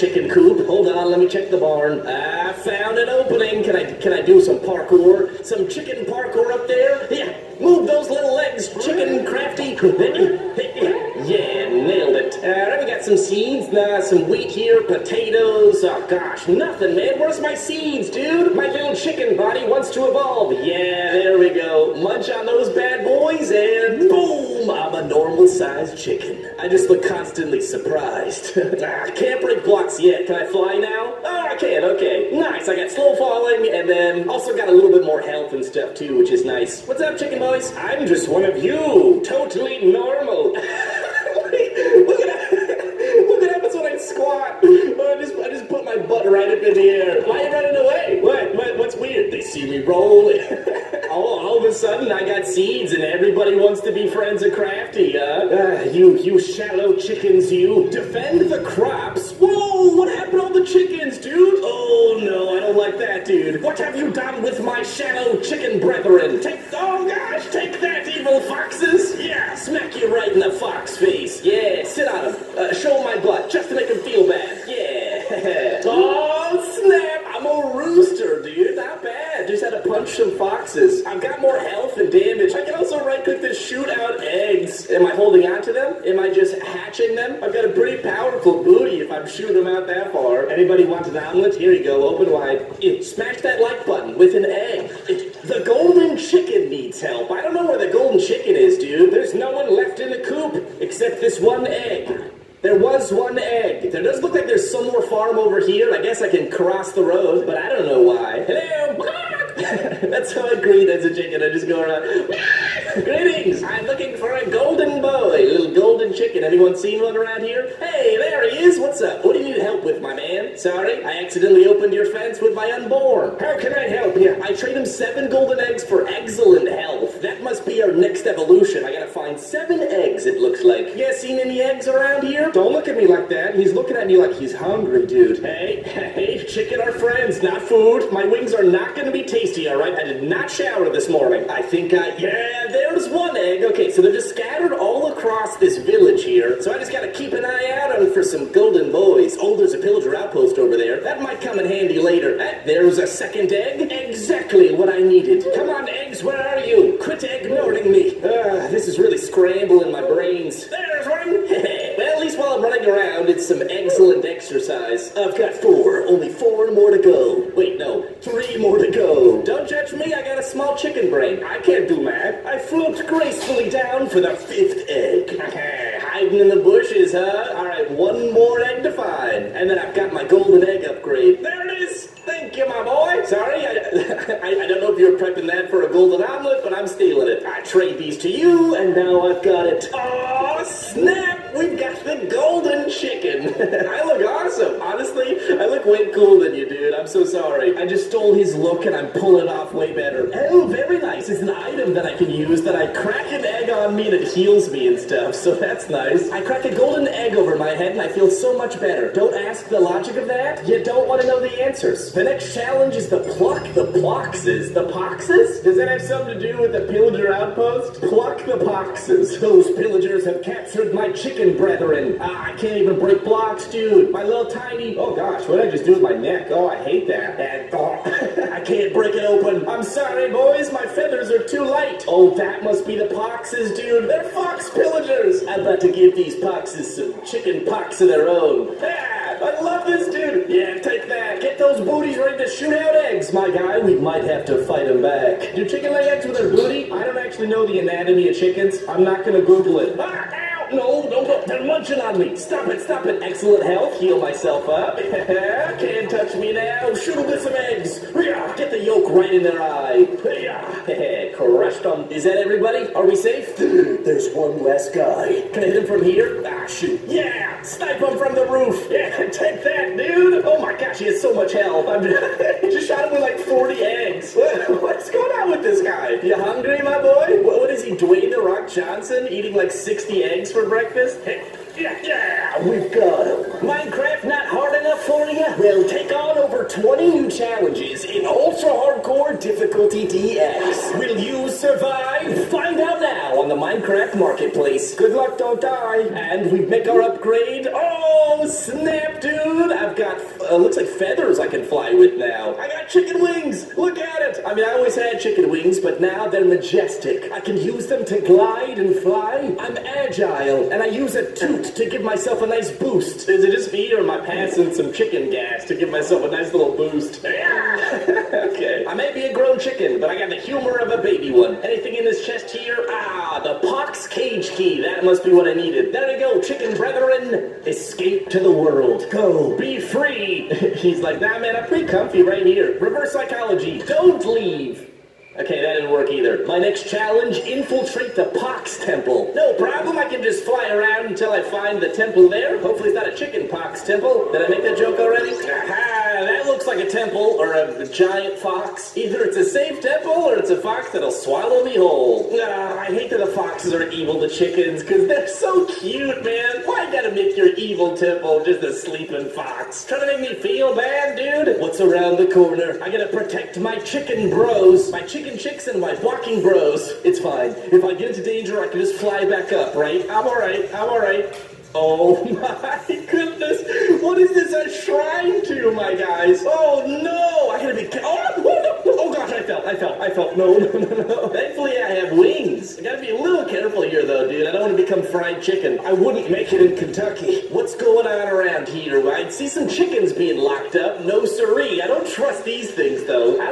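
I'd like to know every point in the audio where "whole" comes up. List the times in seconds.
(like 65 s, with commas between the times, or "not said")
351 s.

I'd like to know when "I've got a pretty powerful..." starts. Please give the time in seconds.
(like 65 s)
87 s.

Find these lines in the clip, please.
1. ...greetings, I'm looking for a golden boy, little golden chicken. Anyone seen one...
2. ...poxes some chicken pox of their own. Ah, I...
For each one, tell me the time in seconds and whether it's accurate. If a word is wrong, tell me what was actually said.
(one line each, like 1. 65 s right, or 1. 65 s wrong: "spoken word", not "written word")
1. 113 s right
2. 236 s right.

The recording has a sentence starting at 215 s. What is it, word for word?
Does that have something to do with the pillager outpost?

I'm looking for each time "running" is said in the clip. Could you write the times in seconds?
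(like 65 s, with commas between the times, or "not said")
47 s, 162 s.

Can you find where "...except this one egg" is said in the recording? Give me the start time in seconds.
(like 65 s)
100 s.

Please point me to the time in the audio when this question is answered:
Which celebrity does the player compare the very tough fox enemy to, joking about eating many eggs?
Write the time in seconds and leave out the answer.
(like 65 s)
277 s.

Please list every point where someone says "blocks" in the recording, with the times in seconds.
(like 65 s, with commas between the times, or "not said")
29 s, 223 s.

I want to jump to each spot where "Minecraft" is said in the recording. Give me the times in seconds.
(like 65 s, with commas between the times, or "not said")
283 s, 293 s.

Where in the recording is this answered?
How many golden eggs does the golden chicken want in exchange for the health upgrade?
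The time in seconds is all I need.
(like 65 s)
124 s.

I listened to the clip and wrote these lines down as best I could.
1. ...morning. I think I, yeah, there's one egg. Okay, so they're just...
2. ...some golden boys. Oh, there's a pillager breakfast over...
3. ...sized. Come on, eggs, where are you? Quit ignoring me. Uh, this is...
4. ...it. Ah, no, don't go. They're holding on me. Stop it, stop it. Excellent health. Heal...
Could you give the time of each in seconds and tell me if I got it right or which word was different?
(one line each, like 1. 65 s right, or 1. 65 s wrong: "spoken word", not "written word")
1. 141 s right
2. 148 s wrong: "outpost", not "breakfast"
3. 154 s wrong: "needed", not "sized"
4. 249 s wrong: "munching", not "holding".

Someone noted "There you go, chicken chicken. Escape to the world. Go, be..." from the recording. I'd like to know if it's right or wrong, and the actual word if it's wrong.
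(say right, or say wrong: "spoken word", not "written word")
wrong: "brethren", not "chicken".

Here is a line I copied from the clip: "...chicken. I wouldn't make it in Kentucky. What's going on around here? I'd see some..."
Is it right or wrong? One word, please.
right.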